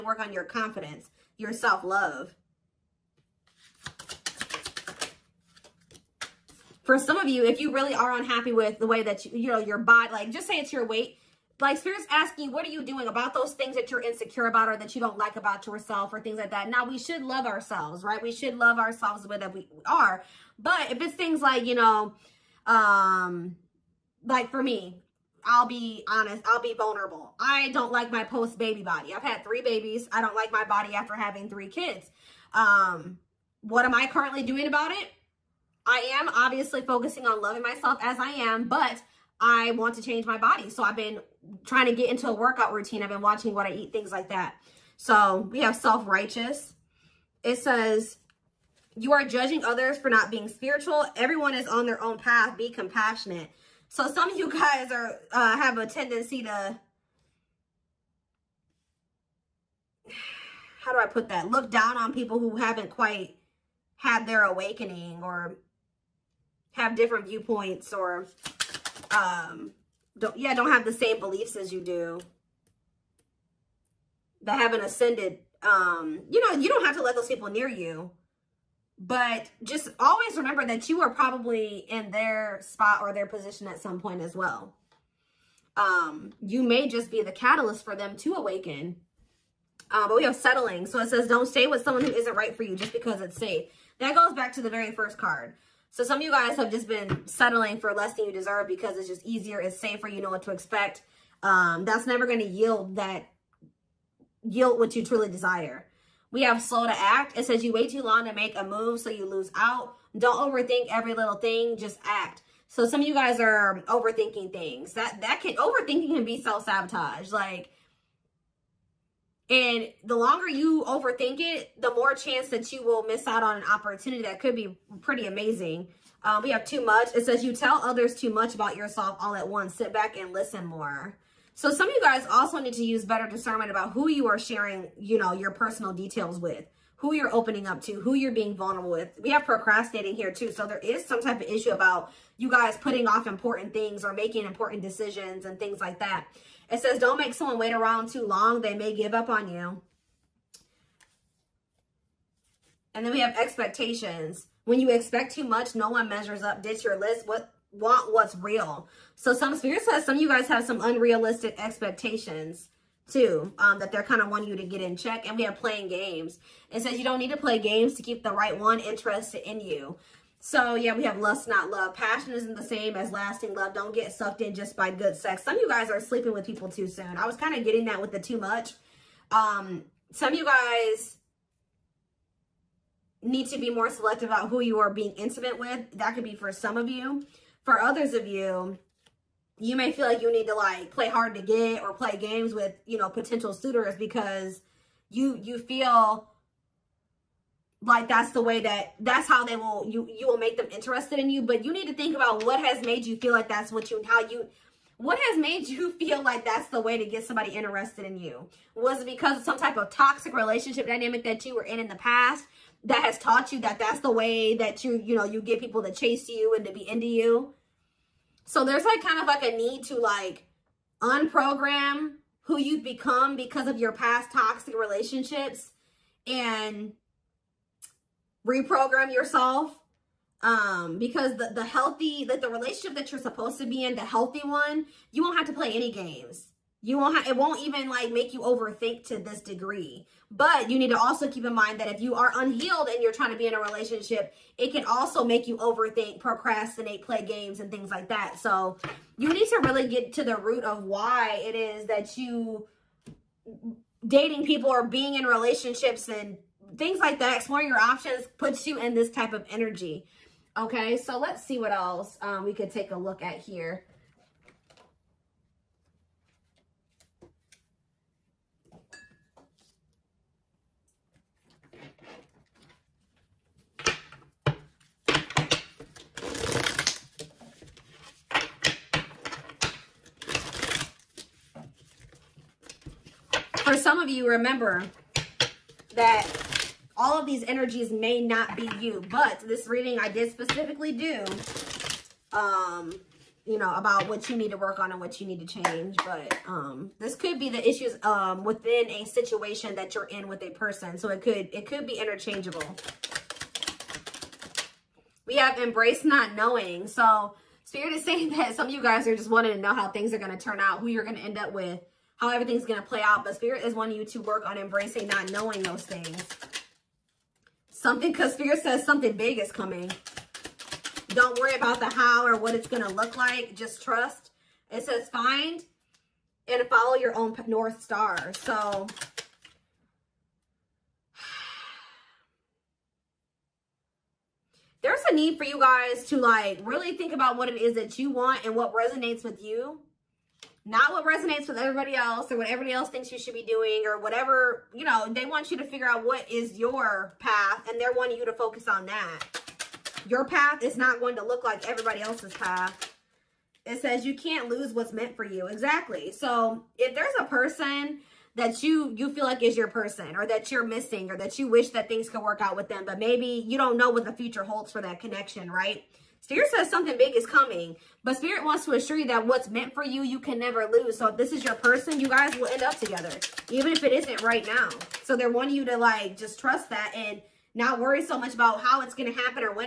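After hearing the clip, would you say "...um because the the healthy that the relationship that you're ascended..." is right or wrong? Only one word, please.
wrong.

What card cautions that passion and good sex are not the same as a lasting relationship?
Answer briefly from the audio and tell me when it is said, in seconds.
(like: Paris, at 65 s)
Lust, not love, at 171 s.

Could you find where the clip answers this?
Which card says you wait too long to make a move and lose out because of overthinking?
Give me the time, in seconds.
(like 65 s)
106 s.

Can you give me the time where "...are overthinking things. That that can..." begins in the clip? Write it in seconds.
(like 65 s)
113 s.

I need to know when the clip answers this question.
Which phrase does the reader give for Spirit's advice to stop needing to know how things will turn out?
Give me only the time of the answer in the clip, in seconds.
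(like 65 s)
305 s.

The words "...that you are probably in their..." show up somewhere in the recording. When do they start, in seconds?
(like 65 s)
80 s.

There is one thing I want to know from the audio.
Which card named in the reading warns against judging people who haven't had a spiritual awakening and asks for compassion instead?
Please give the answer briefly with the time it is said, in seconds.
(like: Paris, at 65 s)
Self-righteous, at 45 s.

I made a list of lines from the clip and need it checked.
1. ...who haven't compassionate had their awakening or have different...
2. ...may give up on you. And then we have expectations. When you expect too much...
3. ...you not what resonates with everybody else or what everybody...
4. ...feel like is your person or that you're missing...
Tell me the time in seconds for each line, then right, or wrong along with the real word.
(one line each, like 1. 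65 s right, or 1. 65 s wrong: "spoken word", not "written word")
1. 62 s wrong: "quite", not "compassionate"
2. 148 s right
3. 339 s right
4. 359 s right.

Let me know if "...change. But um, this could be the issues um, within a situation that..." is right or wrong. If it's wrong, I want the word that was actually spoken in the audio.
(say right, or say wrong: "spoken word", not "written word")
right.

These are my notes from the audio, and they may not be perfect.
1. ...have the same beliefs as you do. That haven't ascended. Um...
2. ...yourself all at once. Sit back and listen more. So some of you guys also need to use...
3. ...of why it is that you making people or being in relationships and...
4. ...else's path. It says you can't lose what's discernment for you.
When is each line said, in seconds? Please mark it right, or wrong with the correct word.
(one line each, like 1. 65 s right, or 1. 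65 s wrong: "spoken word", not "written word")
1. 70 s right
2. 128 s right
3. 250 s wrong: "dating", not "making"
4. 352 s wrong: "meant", not "discernment".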